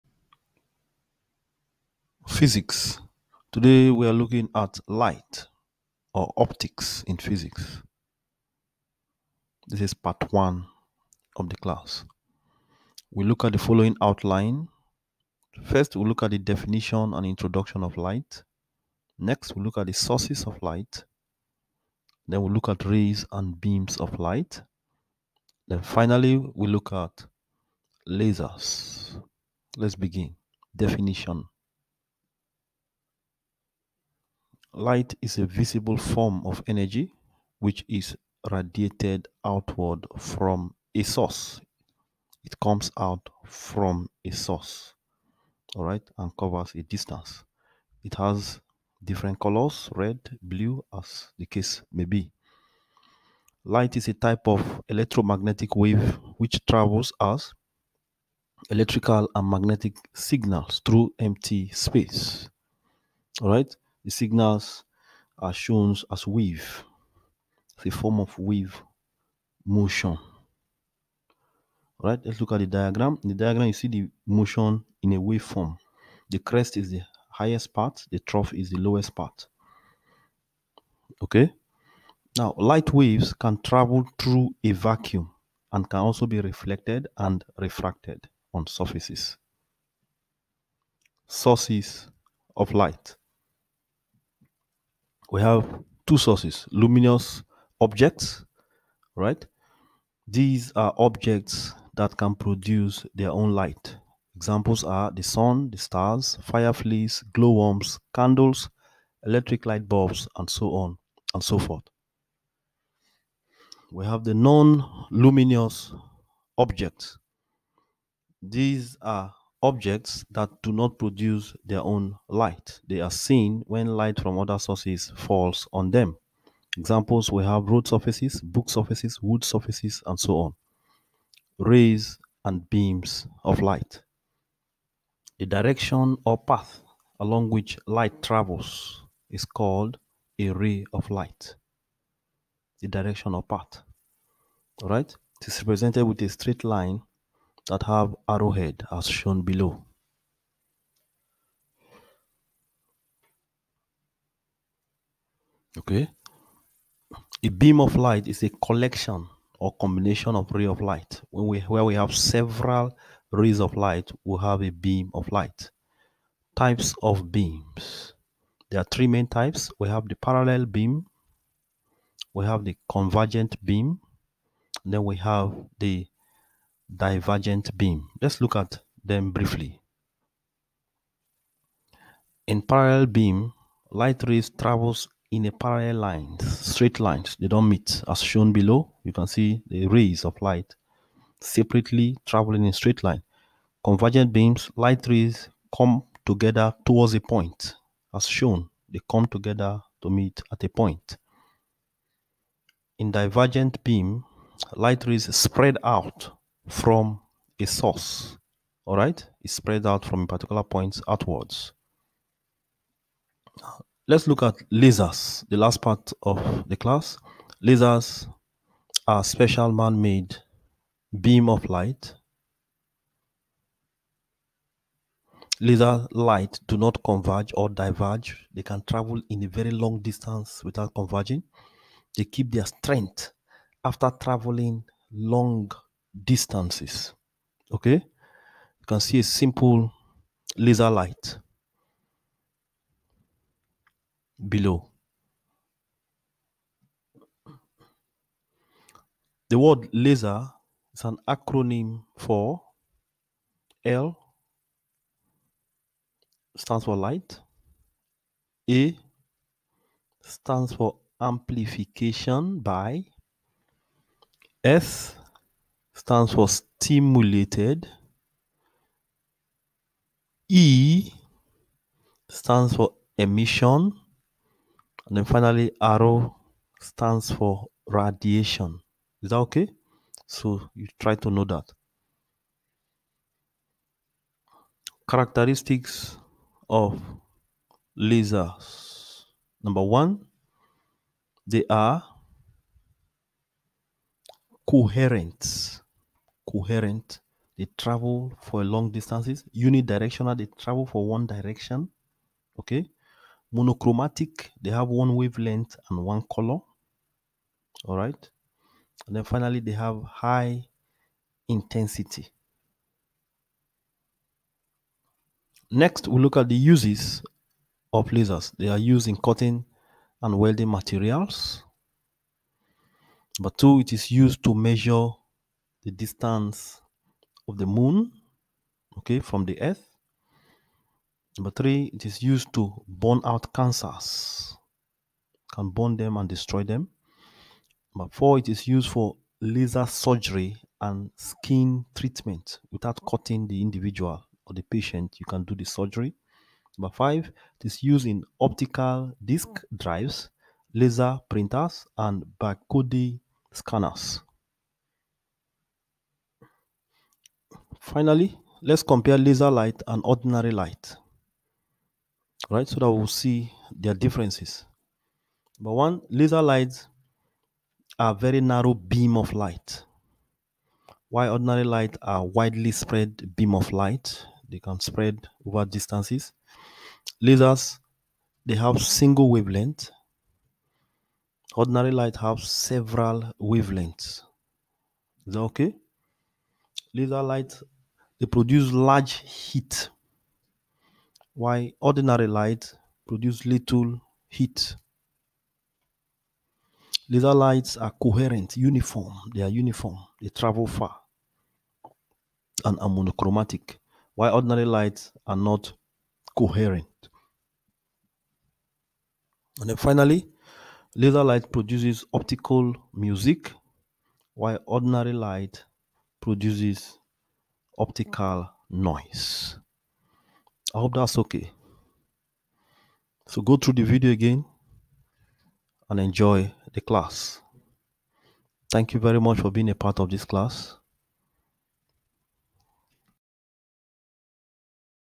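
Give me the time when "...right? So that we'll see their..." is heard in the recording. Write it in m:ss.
6:02.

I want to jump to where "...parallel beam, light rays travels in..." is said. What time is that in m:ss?
3:02.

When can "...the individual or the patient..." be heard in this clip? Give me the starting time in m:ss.
5:43.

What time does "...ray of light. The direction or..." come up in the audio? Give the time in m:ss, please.
2:20.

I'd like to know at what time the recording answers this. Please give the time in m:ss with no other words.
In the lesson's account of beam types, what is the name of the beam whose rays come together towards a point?
2:52.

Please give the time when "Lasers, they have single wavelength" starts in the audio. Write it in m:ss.
6:17.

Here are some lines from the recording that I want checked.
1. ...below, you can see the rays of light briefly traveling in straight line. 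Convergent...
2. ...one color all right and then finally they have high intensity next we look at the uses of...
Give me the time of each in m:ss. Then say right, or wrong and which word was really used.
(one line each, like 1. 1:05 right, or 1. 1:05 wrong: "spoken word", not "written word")
1. 3:08 wrong: "separately", not "briefly"
2. 5:06 right.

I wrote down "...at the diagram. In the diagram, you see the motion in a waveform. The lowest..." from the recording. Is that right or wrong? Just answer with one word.
wrong.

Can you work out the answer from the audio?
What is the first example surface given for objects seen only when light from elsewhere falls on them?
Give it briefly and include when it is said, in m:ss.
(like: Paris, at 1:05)
Road surfaces, at 2:07.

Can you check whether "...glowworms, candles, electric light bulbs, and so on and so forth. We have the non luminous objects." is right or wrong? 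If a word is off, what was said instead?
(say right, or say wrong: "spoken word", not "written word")
right.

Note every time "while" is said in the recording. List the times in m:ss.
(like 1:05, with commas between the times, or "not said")
6:11, 6:31, 6:44, 6:54.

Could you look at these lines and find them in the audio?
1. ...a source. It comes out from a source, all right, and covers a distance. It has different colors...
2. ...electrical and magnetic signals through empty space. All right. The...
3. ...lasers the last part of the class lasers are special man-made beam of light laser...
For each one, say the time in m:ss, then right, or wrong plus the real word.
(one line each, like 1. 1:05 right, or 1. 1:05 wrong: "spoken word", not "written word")
1. 0:40 right
2. 0:58 right
3. 3:34 right.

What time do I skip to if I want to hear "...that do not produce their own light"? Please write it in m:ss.
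2:00.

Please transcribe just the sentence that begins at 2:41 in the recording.
When we where we have several rays of light, we have a beam of light.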